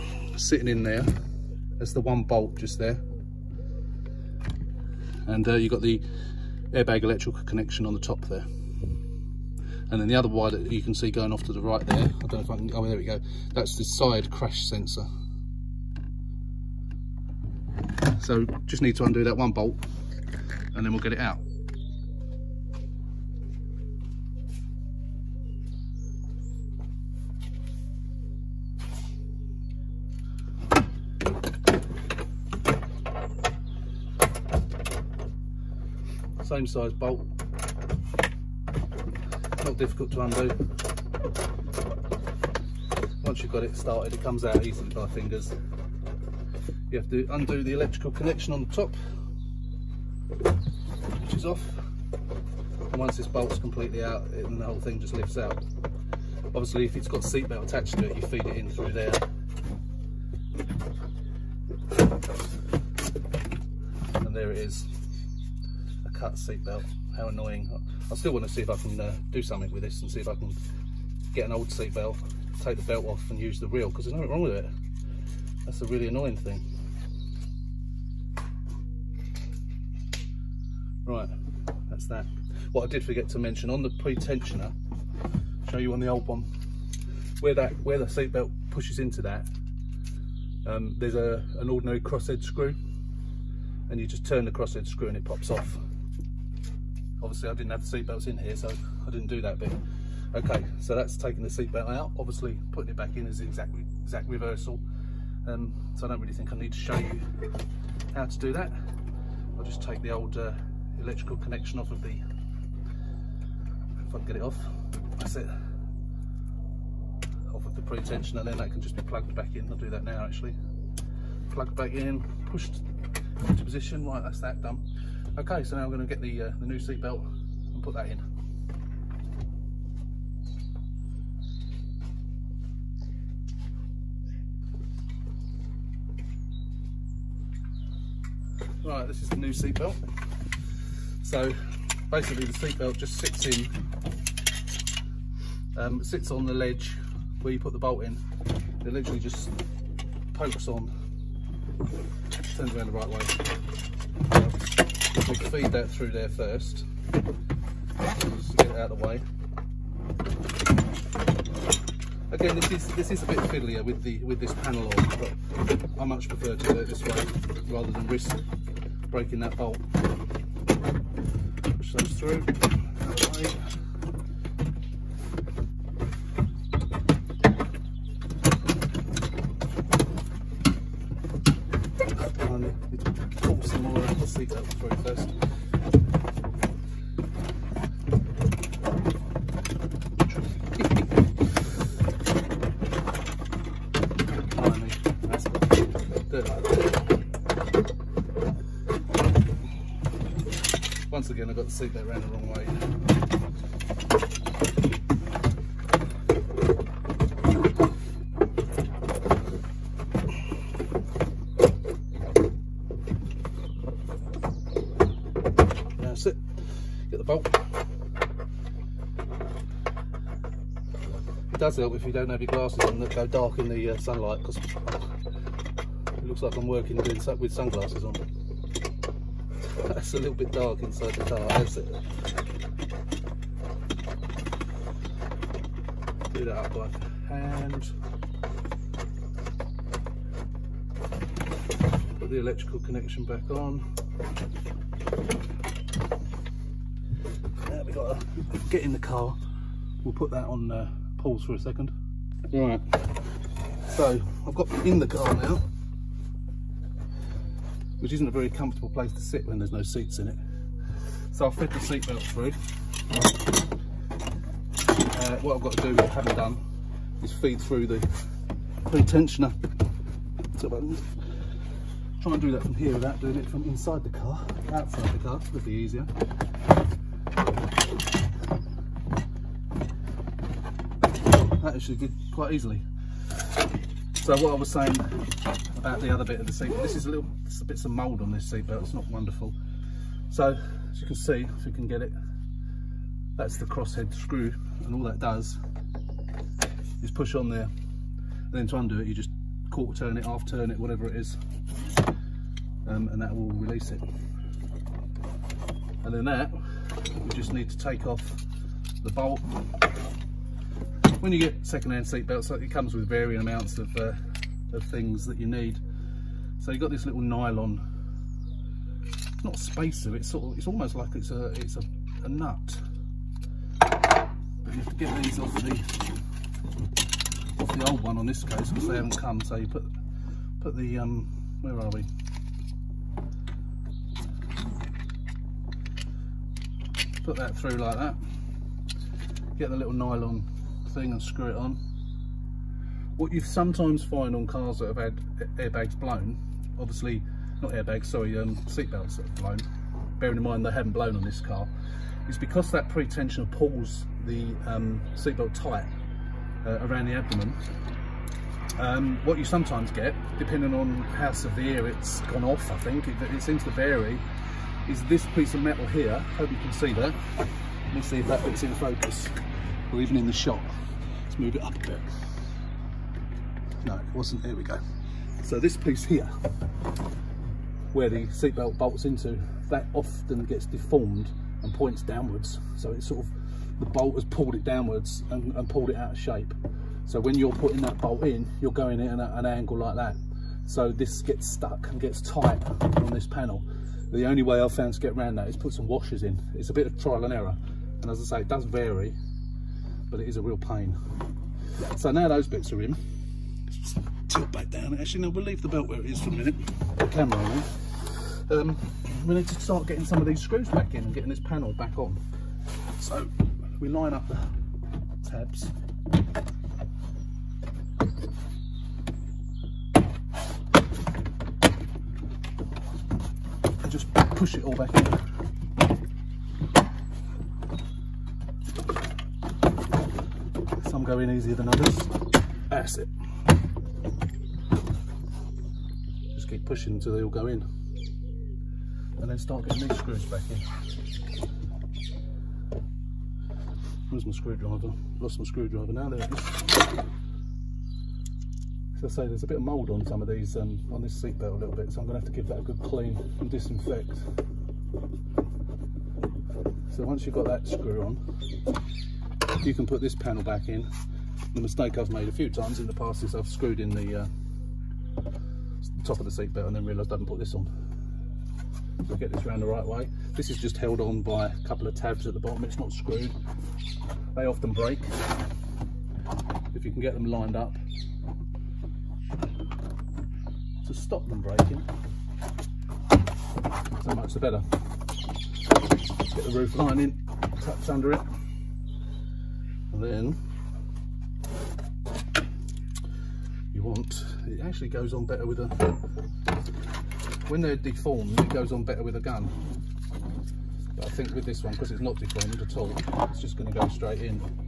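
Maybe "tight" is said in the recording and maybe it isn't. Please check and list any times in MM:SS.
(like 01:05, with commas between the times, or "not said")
05:55, 06:32.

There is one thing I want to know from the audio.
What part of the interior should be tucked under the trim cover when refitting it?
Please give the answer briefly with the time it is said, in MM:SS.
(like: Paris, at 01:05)
Roof lining, at 08:06.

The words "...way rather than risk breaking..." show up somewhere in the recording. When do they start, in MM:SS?
02:47.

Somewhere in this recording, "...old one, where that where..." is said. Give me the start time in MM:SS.
01:26.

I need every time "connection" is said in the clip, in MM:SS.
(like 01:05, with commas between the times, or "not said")
00:07, 00:48, 01:51, 04:02.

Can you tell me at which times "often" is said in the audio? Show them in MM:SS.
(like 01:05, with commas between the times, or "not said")
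06:19, 07:54.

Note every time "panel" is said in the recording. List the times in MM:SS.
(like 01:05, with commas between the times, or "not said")
02:44, 06:33, 06:51, 07:40.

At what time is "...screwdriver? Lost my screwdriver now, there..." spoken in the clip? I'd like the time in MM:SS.
07:24.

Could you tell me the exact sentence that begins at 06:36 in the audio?
It's a bit of trial and error.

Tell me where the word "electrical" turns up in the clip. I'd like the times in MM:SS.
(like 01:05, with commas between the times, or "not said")
00:07, 00:47, 01:50, 04:02.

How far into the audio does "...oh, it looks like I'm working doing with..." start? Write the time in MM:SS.
03:44.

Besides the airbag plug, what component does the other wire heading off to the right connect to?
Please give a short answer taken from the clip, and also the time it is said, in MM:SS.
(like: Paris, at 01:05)
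Side crash sensor, at 00:13.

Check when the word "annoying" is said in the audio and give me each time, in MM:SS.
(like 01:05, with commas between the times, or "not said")
01:07, 01:16.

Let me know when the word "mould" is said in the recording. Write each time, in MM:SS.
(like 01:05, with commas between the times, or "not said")
04:47, 07:29.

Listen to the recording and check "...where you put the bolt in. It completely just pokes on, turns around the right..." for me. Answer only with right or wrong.
wrong.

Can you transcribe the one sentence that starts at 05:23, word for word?
But you have to get these off the, off the old one on this case because they haven't come.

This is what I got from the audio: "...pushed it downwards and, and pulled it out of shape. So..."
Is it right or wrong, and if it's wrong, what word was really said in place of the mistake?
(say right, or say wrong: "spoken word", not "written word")
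wrong: "pulled", not "pushed".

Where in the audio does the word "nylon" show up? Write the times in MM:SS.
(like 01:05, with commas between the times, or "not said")
05:17, 05:39.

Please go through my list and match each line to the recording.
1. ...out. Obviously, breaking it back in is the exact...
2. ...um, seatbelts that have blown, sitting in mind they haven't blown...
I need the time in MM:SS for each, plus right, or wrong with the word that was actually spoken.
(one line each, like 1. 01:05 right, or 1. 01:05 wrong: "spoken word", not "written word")
1. 01:41 wrong: "putting", not "breaking"
2. 05:48 wrong: "bearing", not "sitting".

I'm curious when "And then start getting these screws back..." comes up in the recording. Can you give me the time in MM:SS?
07:19.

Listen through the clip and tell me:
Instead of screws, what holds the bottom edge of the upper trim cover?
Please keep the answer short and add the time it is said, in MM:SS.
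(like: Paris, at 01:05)
A couple of tabs, at 07:51.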